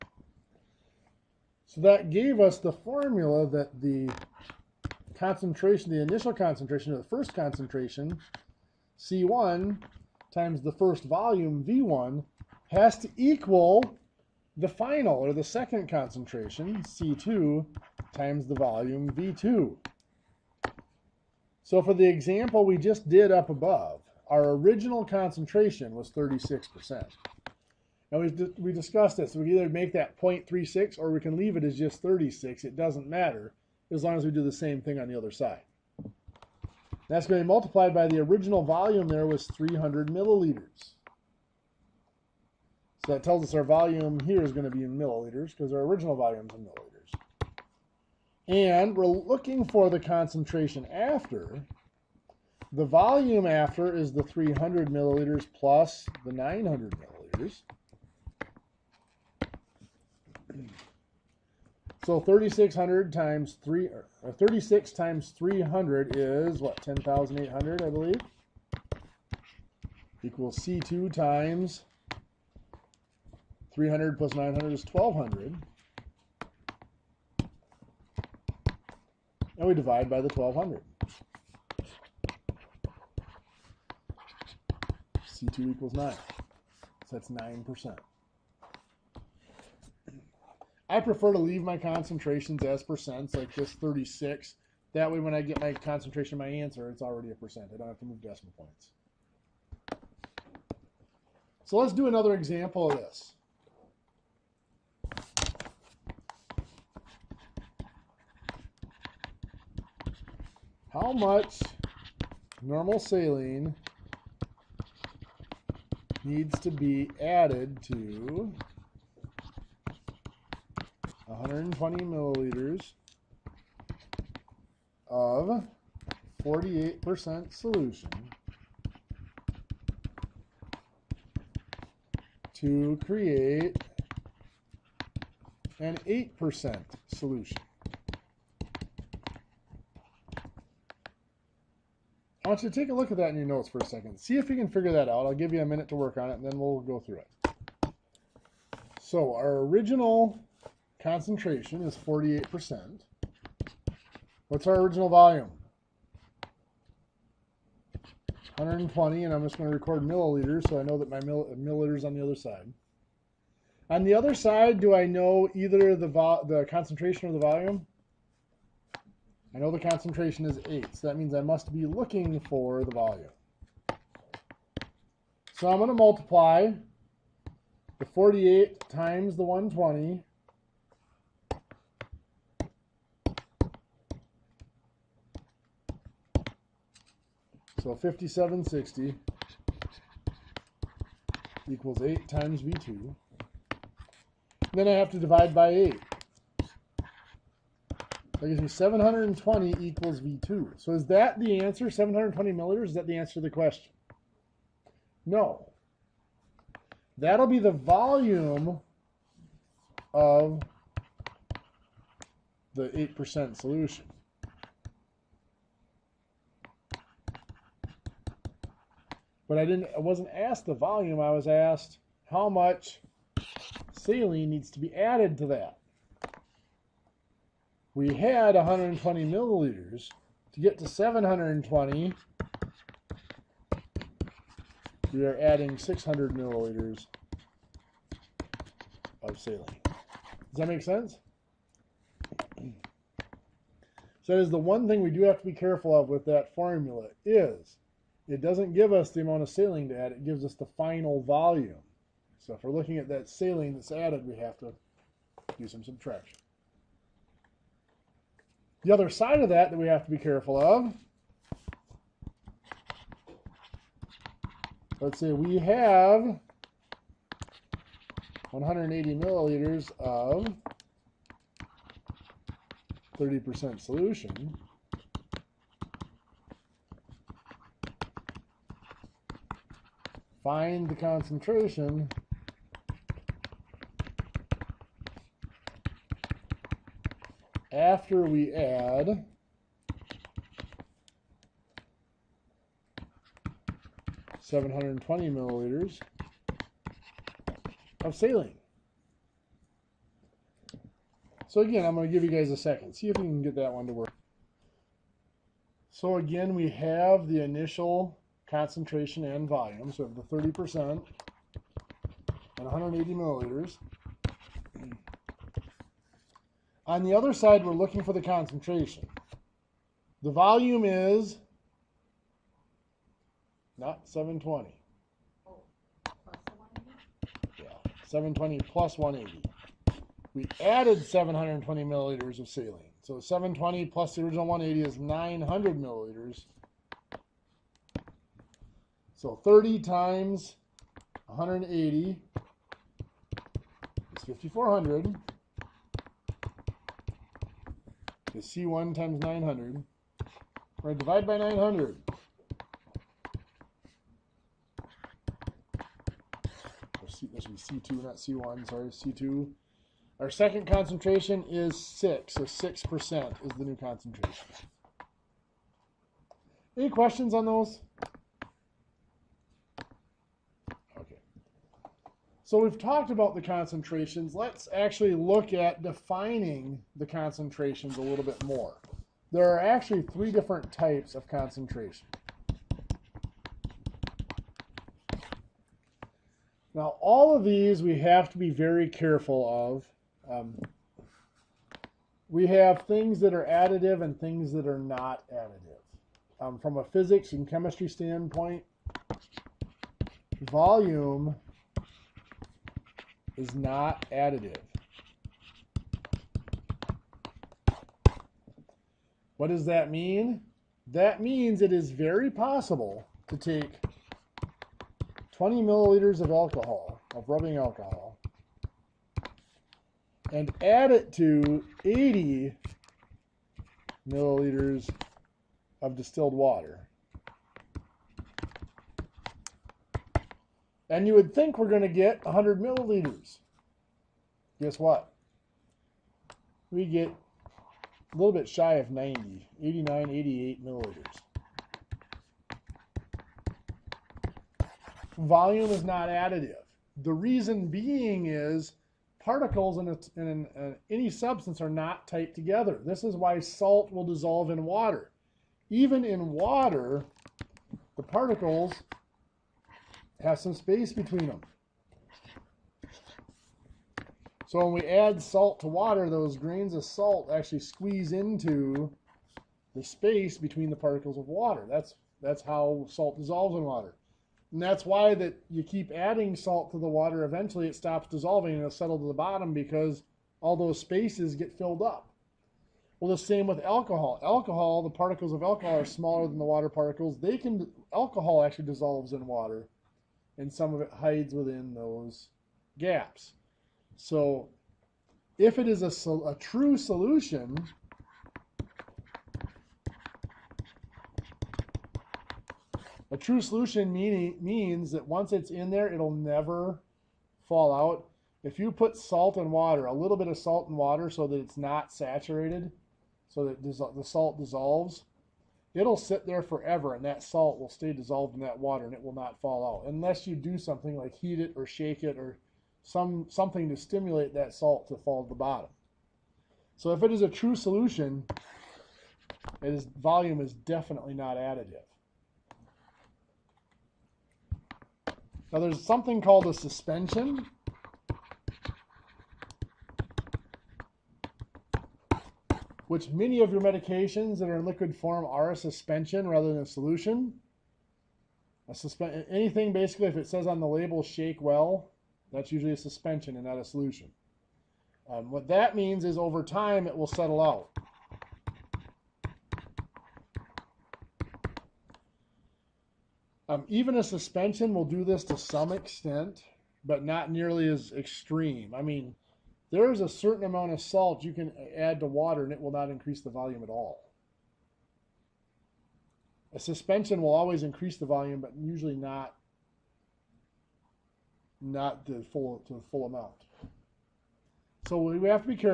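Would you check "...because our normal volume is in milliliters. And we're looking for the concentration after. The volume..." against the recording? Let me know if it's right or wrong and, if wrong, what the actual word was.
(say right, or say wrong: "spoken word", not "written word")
wrong: "original", not "normal".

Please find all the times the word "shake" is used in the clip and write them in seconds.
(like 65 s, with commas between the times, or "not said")
521 s, 551 s.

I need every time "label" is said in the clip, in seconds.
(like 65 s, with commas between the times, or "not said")
550 s.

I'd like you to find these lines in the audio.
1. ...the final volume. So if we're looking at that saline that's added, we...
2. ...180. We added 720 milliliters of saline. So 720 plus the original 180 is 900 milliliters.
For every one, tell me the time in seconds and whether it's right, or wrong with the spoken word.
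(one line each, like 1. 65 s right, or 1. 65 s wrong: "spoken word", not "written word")
1. 250 s right
2. 328 s right.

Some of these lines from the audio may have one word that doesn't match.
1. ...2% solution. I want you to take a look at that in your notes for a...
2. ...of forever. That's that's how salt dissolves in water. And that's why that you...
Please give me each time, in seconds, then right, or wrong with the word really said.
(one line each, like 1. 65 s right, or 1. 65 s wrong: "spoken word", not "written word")
1. 136 s wrong: "8", not "2"
2. 471 s wrong: "water", not "forever".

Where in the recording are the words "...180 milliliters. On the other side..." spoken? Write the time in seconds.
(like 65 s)
312 s.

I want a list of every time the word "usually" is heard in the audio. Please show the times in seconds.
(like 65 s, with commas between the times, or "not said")
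552 s, 578 s.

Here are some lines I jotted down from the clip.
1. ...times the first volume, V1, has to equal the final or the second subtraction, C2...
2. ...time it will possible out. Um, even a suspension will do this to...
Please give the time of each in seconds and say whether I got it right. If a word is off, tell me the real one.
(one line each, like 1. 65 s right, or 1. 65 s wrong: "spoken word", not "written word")
1. 10 s wrong: "concentration", not "subtraction"
2. 556 s wrong: "settle", not "possible".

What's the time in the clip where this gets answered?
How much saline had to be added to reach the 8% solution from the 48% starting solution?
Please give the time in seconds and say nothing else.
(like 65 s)
235 s.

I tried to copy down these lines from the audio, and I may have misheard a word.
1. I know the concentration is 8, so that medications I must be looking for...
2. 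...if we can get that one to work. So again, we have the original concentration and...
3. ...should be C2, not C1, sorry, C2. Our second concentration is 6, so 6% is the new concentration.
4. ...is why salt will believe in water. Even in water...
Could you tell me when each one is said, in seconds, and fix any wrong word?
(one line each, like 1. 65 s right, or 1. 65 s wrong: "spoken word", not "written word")
1. 169 s wrong: "means", not "medications"
2. 303 s wrong: "initial", not "original"
3. 357 s right
4. 453 s wrong: "dissolve", not "believe".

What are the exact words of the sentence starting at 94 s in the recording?
That way, when I get my concentration, my answer, it's already a percent.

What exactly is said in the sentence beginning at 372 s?
So we've talked about the concentrations.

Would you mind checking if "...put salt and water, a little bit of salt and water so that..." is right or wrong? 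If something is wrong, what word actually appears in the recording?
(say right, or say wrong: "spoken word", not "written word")
right.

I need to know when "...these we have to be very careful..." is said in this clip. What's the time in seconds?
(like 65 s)
387 s.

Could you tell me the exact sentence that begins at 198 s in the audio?
That gives me 720 equals V2.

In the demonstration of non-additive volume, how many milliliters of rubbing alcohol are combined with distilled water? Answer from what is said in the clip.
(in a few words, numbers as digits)
20 milliliters.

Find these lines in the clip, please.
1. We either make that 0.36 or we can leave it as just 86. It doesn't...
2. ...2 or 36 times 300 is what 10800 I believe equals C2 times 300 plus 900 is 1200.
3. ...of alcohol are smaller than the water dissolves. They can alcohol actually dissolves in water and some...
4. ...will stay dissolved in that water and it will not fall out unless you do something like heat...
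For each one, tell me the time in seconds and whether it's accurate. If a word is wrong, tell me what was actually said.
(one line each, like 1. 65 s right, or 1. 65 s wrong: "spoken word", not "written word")
1. 29 s wrong: "36", not "86"
2. 63 s wrong: "3", not "2"
3. 485 s wrong: "particles", not "dissolves"
4. 517 s right.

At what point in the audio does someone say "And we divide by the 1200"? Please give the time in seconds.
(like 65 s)
79 s.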